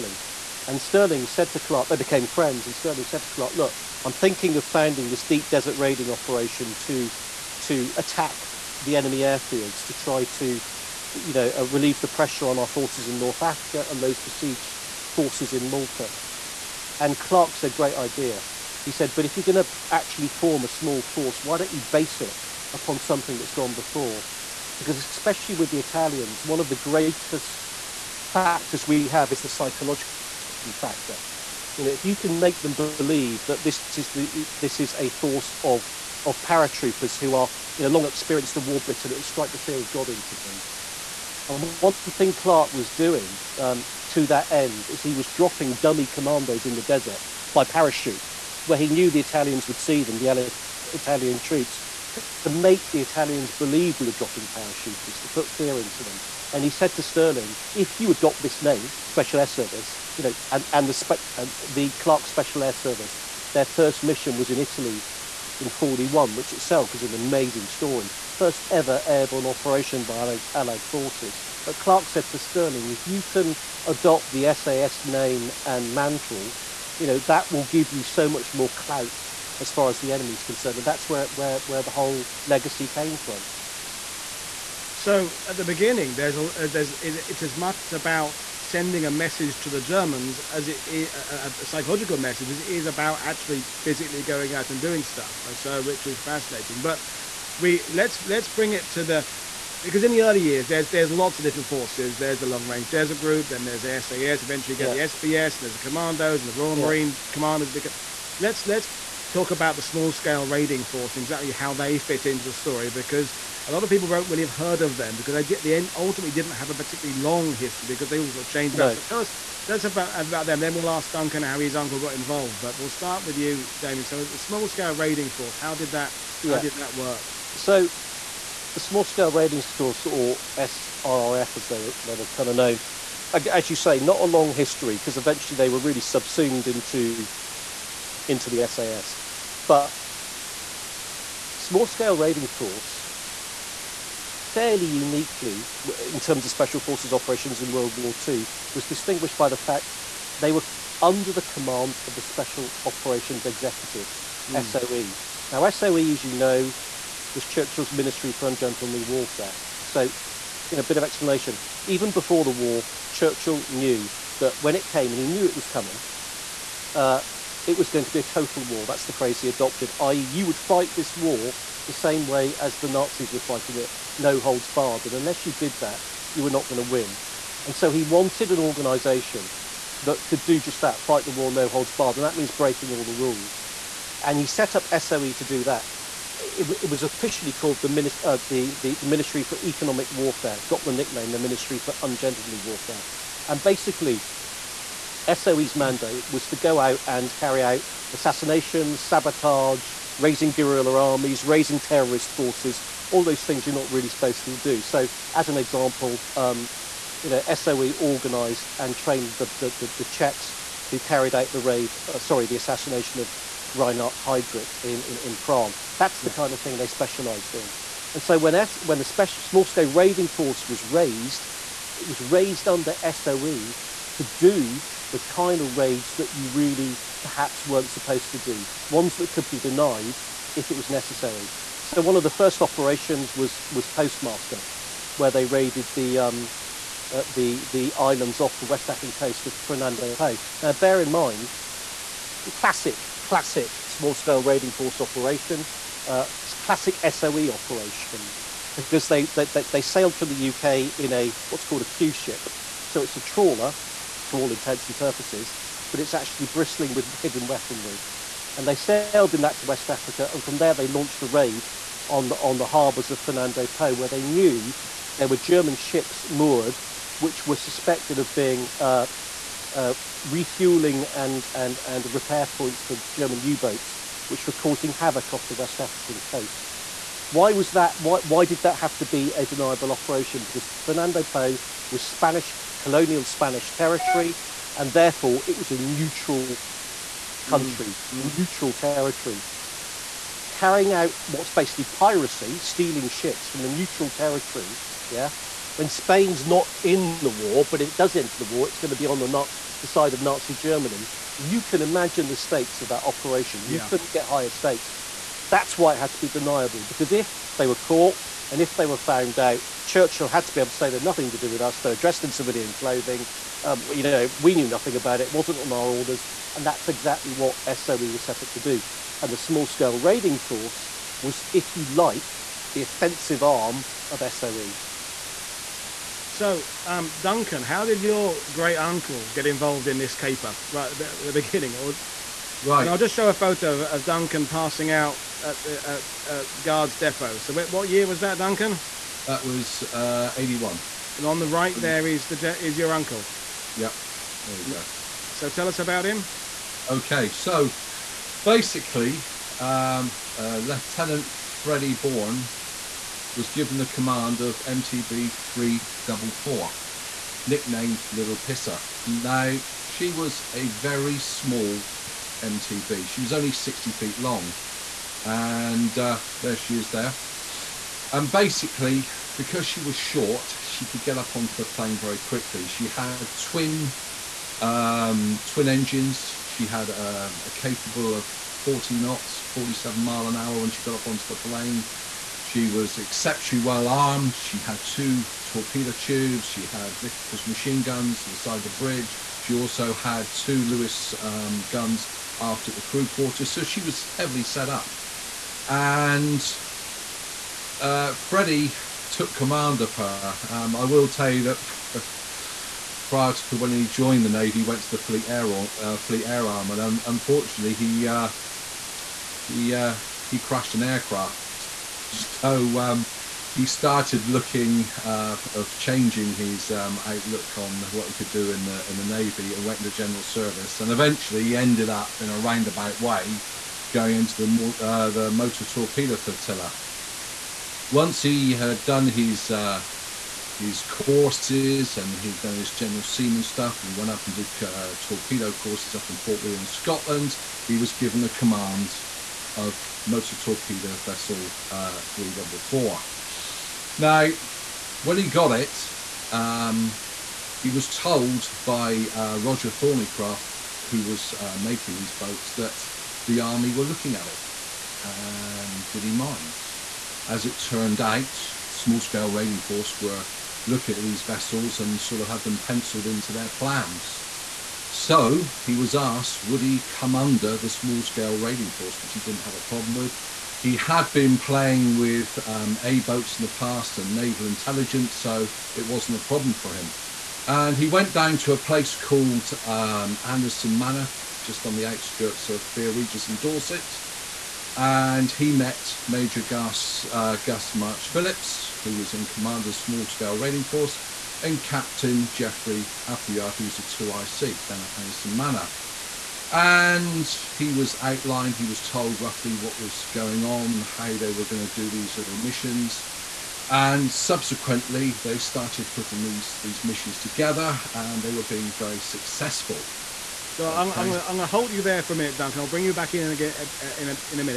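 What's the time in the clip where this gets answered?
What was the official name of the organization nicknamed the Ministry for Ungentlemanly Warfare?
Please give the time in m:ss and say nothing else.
3:09.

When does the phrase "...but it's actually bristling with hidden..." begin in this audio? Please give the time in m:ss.
4:15.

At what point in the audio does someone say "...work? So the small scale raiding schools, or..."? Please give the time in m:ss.
2:06.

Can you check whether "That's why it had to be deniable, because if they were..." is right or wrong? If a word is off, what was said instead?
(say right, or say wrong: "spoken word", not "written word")
right.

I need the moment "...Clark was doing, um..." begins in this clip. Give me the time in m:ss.
0:42.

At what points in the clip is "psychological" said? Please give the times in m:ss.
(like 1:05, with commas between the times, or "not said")
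0:29, 1:31.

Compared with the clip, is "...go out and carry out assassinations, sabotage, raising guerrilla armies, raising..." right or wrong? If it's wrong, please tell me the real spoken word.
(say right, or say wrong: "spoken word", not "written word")
right.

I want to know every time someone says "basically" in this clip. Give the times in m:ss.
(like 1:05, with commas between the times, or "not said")
3:13, 4:51, 5:48, 6:08.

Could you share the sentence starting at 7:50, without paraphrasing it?
He had been playing with um, A boats in the past and naval intelligence, so it wasn't a problem for him.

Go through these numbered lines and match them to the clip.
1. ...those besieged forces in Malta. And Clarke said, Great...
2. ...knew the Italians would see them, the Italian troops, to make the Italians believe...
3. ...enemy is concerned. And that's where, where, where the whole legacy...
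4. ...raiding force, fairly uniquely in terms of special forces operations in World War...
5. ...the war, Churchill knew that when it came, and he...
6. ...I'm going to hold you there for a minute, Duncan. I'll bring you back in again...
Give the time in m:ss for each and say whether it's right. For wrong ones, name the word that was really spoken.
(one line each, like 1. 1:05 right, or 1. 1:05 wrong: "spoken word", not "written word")
1. 0:14 right
2. 0:48 right
3. 1:20 right
4. 2:22 right
5. 2:42 right
6. 8:31 right.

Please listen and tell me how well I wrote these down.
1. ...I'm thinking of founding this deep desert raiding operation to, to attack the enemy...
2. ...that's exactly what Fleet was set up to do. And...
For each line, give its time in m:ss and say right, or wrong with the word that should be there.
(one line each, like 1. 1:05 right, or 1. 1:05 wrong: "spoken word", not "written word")
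1. 0:04 right
2. 5:16 wrong: "SOE", not "Fleet".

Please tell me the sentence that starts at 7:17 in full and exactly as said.
He was given the command of motor torpedo vessel uh, 344.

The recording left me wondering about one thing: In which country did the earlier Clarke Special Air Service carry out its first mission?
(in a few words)
Italy.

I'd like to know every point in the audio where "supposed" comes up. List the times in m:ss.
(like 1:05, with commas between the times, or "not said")
3:24, 3:47.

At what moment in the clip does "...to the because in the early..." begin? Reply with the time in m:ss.
1:38.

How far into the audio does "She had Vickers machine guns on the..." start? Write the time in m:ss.
6:26.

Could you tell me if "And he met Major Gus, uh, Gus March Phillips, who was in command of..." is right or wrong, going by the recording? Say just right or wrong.
right.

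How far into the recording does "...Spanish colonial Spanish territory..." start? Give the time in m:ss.
4:42.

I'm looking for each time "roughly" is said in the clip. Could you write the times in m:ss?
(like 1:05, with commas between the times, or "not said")
8:19.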